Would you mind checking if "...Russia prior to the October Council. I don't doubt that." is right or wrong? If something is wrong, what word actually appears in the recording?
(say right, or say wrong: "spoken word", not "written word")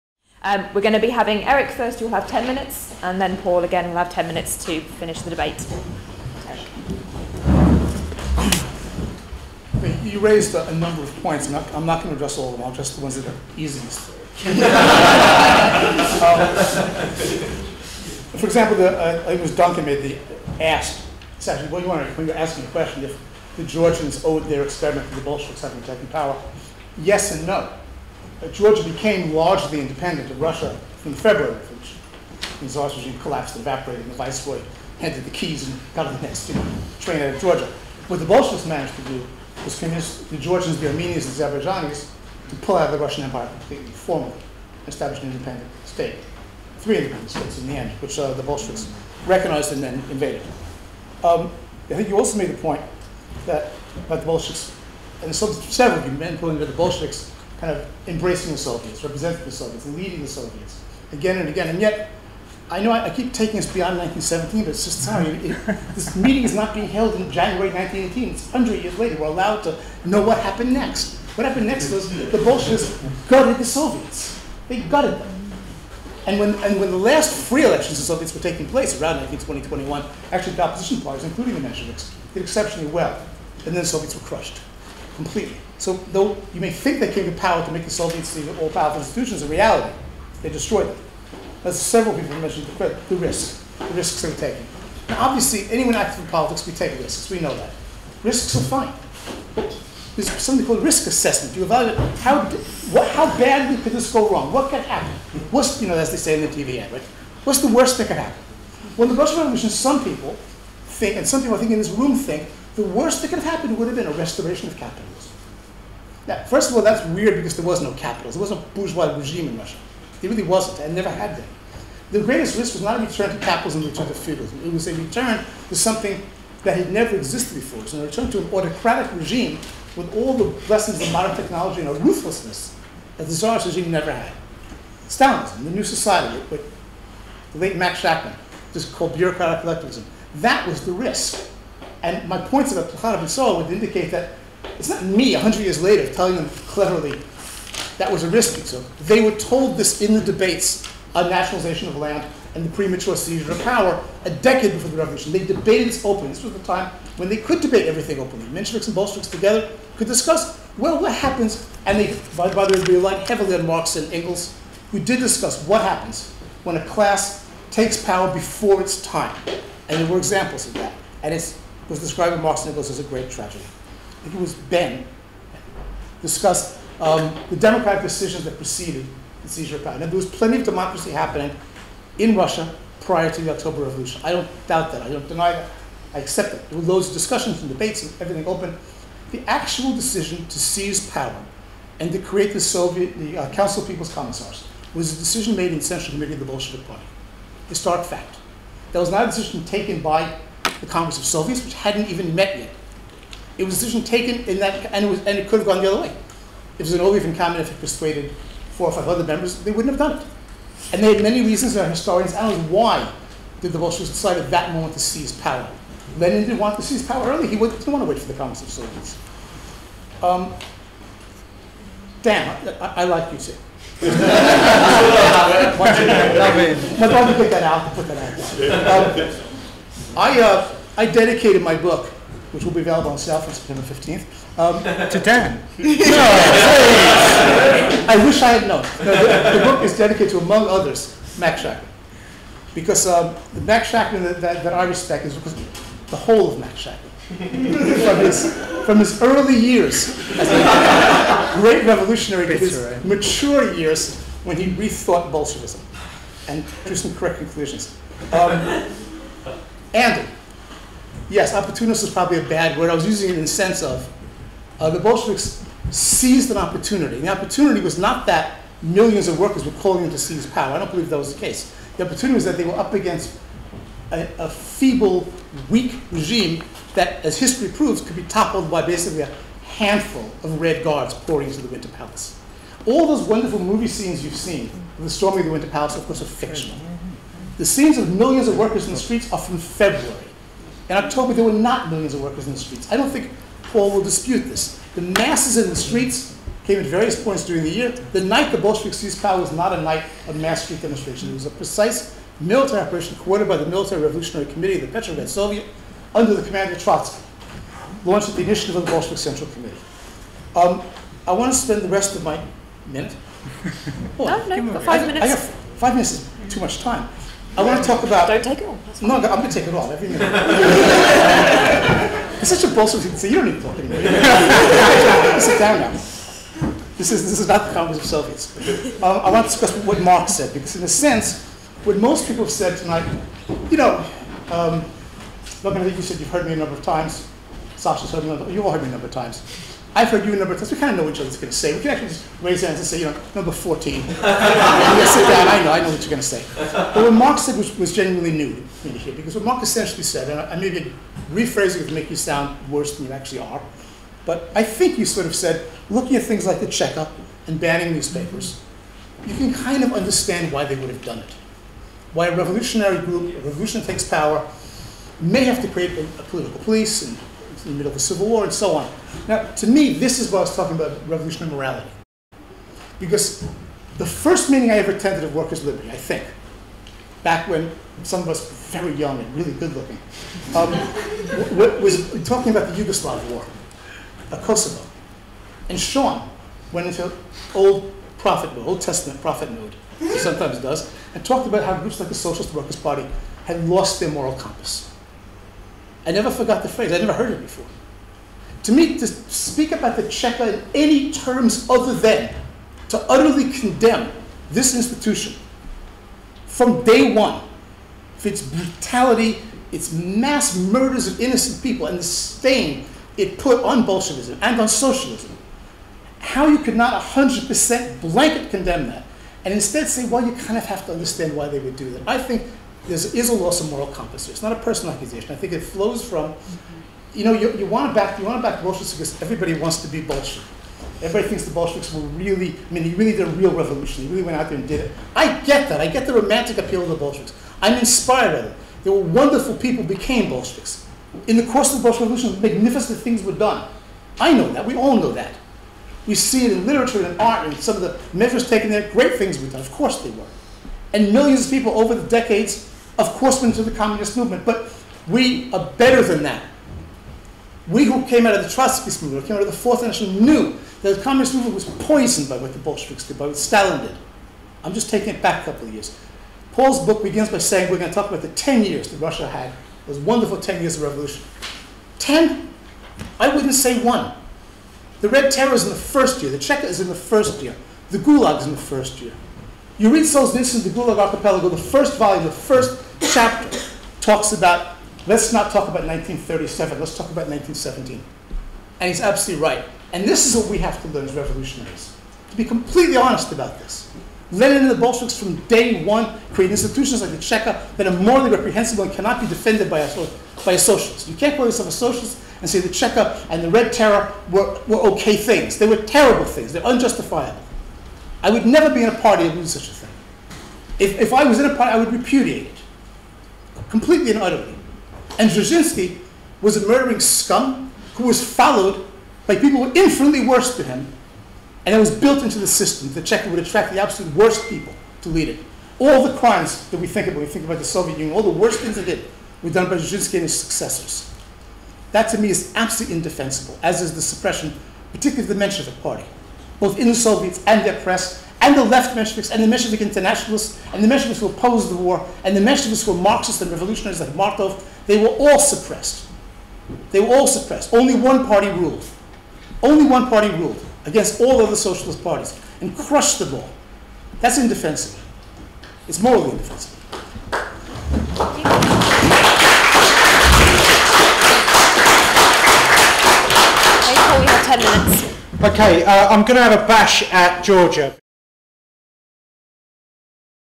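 wrong: "Revolution", not "Council".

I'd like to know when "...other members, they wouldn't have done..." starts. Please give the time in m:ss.
3:29.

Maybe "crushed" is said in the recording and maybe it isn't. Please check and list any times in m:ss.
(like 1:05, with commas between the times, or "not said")
1:24, 9:12.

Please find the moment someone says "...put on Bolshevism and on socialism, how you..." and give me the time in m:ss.
6:53.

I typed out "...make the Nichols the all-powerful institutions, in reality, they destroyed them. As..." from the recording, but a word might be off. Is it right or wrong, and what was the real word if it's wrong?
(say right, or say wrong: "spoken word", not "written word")
wrong: "Soviets", not "Nichols".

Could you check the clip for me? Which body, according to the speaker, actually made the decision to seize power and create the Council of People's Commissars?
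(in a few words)
Bolshevik Central Committee.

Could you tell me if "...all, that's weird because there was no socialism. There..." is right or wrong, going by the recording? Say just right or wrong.
wrong.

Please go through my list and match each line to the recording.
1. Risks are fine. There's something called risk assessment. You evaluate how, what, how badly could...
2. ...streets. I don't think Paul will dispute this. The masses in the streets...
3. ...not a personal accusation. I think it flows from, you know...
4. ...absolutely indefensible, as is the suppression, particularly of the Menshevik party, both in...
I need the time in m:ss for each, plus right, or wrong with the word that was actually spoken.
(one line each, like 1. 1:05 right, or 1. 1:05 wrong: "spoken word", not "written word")
1. 1:38 right
2. 4:52 right
3. 7:04 right
4. 8:52 right.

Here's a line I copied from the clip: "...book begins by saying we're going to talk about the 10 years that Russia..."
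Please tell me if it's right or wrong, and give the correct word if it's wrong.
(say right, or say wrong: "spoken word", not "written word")
right.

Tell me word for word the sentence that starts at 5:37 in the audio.
Sasha's heard me a number, you've all heard me a number of times.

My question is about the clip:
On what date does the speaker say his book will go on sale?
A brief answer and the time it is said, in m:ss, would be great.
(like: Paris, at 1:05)
September 15th, at 3:53.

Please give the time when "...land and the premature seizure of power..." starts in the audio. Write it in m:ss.
2:31.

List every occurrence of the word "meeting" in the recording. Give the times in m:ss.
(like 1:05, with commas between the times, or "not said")
1:06, 6:14.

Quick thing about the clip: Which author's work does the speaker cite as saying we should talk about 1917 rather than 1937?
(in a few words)
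Solzhenitsyn.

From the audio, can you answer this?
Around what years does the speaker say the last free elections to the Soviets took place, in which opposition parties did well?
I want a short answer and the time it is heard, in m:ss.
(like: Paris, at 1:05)
1920-21, at 1:19.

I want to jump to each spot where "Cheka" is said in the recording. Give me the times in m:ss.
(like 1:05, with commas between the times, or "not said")
5:56, 6:40, 7:56, 8:17, 8:22, 8:43.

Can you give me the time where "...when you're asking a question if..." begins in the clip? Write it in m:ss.
0:22.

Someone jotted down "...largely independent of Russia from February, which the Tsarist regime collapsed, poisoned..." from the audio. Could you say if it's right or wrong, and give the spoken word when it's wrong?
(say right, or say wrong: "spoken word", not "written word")
wrong: "evaporated", not "poisoned".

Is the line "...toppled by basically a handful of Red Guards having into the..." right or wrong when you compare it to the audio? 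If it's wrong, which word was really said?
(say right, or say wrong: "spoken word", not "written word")
wrong: "pouring", not "having".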